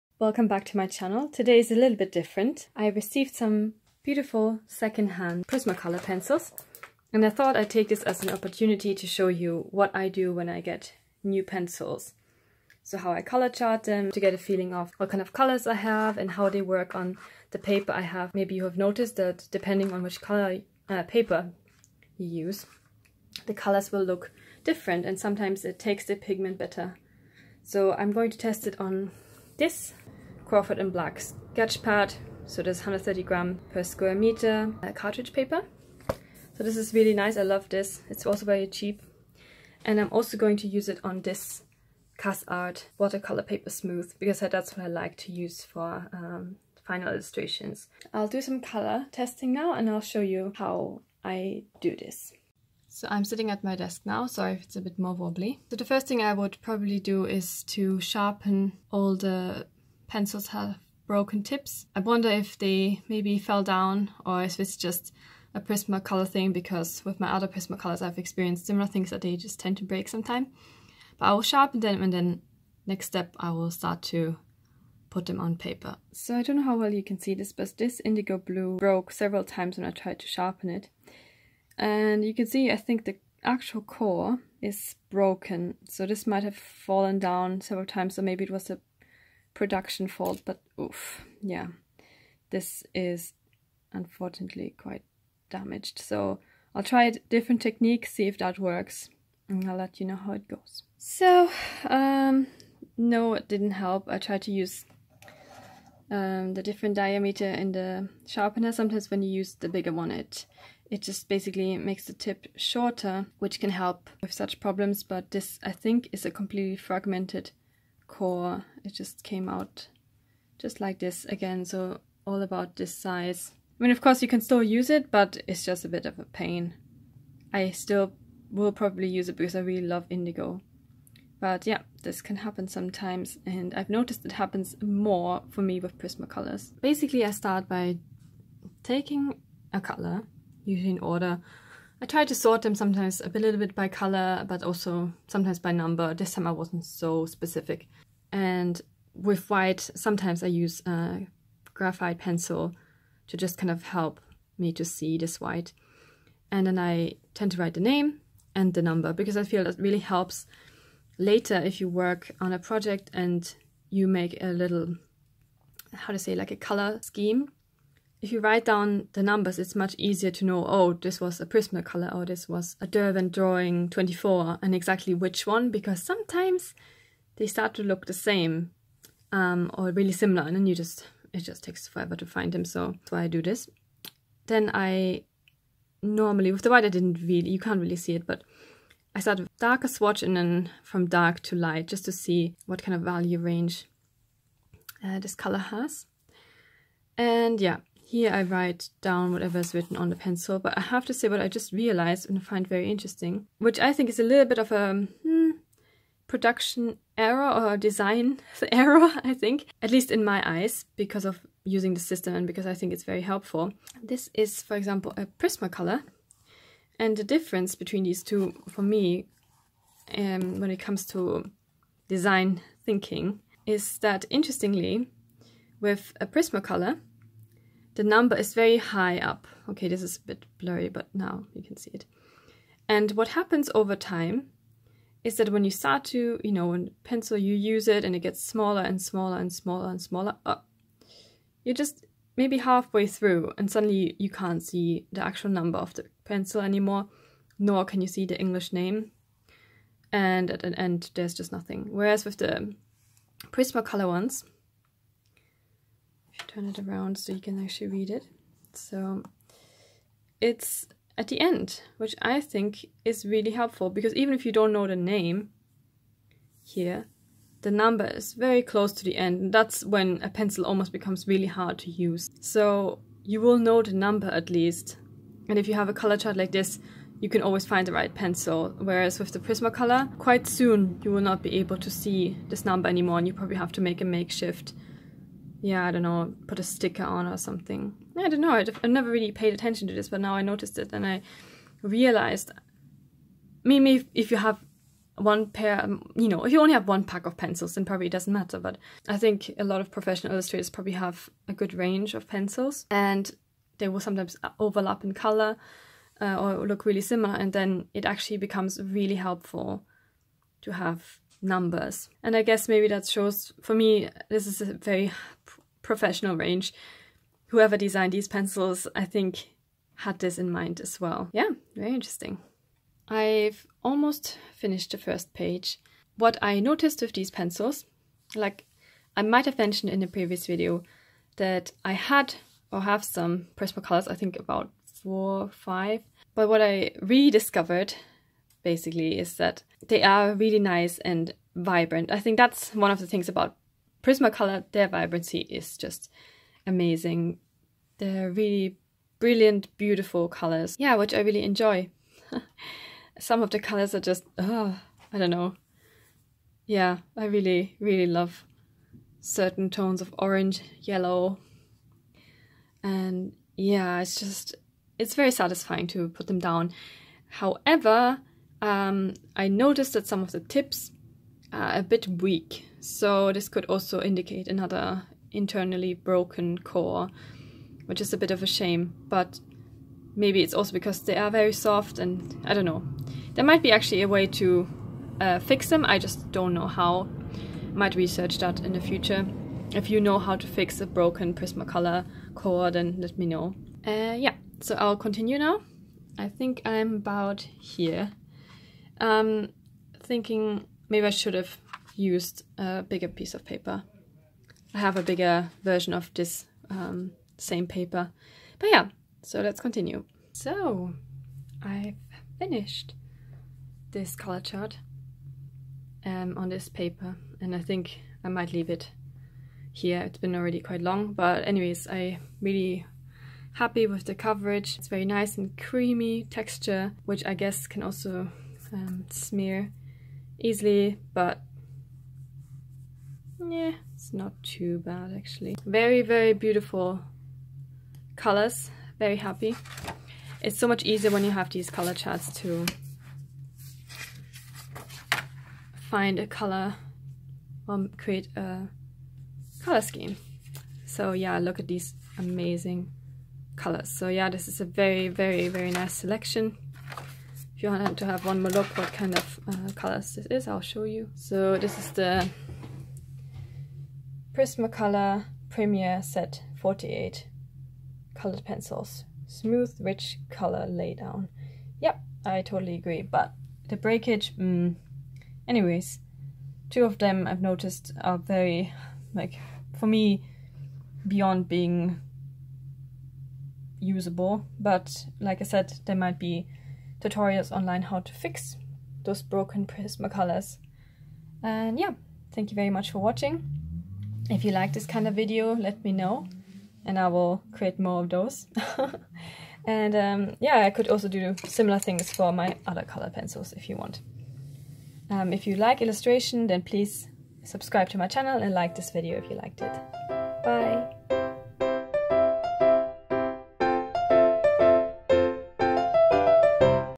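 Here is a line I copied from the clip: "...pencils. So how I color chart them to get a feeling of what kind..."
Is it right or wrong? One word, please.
right.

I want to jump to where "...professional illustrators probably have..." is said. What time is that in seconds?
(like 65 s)
299 s.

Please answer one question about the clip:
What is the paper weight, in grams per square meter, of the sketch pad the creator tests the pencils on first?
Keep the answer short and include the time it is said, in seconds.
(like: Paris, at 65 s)
130, at 32 s.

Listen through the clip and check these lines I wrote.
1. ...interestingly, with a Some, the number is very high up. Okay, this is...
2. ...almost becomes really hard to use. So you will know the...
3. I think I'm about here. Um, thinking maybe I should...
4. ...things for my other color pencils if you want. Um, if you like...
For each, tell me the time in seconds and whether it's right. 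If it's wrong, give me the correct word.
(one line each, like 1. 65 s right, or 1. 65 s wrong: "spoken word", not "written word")
1. 224 s wrong: "Prismacolor", not "Some"
2. 270 s right
3. 396 s right
4. 501 s right.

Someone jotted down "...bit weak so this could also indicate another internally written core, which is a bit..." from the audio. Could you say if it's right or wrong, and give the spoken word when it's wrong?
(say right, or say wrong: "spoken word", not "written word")
wrong: "broken", not "written".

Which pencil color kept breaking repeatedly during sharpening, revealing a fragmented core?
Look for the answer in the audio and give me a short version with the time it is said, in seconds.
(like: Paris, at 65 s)
Indigo blue, at 78 s.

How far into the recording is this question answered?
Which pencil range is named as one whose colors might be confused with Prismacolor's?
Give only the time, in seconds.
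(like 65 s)
172 s.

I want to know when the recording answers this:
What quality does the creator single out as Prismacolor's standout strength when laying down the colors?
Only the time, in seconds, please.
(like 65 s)
344 s.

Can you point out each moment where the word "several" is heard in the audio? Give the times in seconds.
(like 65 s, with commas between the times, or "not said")
79 s, 87 s.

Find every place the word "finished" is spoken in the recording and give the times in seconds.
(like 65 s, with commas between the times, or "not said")
324 s, 412 s.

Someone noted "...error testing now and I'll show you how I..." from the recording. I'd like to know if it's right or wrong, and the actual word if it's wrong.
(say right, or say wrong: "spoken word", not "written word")
wrong: "color", not "error".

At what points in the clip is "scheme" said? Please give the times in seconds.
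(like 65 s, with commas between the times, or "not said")
167 s, 449 s.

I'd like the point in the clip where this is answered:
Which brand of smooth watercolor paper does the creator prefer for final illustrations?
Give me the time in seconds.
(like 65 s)
42 s.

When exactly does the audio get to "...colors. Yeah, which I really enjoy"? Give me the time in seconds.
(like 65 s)
350 s.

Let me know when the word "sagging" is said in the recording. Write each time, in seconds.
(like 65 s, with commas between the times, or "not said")
not said.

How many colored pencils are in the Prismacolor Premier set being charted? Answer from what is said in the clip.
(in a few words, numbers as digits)
48.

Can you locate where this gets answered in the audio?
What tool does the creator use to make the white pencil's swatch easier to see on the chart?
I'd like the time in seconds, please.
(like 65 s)
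151 s.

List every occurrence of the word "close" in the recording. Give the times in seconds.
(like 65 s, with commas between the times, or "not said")
268 s.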